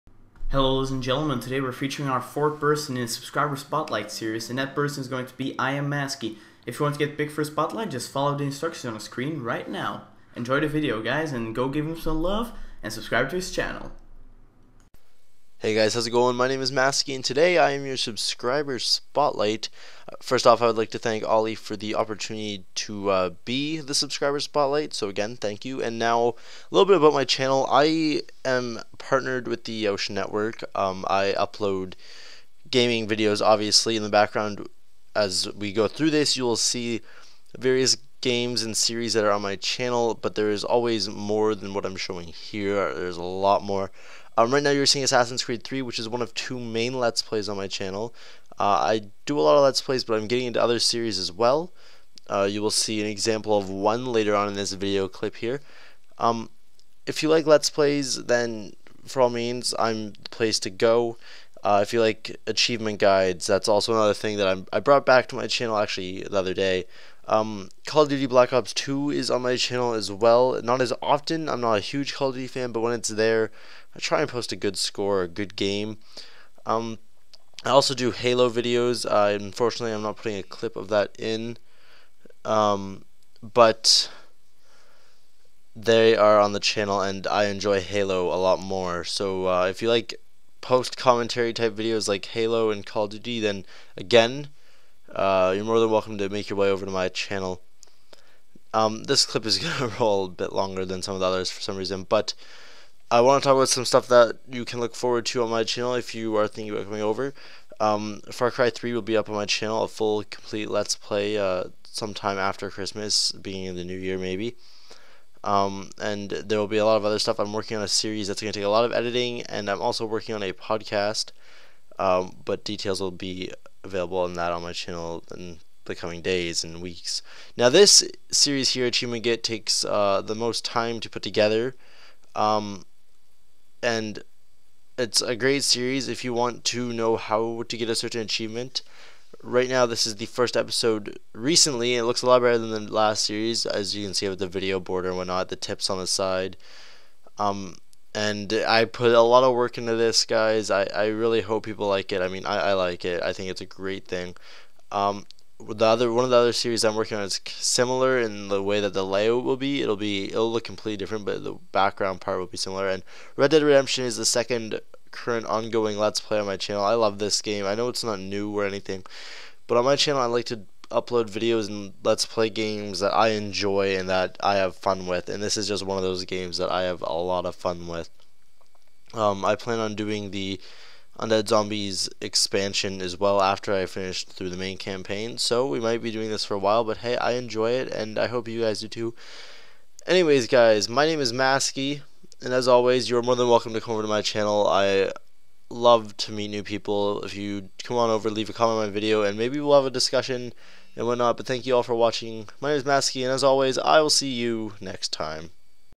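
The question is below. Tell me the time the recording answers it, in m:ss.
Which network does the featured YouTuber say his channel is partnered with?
0:29.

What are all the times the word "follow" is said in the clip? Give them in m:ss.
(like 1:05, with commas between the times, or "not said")
0:08.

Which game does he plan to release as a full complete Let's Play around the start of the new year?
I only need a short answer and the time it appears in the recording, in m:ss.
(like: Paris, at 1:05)
Far Cry 3, at 1:48.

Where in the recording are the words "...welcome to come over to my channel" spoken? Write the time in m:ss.
3:13.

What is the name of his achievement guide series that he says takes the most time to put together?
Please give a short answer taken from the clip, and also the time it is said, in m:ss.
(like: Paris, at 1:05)
Achievement Get, at 2:08.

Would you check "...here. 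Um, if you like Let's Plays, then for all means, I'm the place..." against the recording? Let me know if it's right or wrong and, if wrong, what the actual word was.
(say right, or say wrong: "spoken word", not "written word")
right.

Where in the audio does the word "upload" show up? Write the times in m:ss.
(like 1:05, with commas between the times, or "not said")
0:31, 2:50.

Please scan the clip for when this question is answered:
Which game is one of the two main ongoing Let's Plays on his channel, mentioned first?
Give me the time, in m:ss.
0:45.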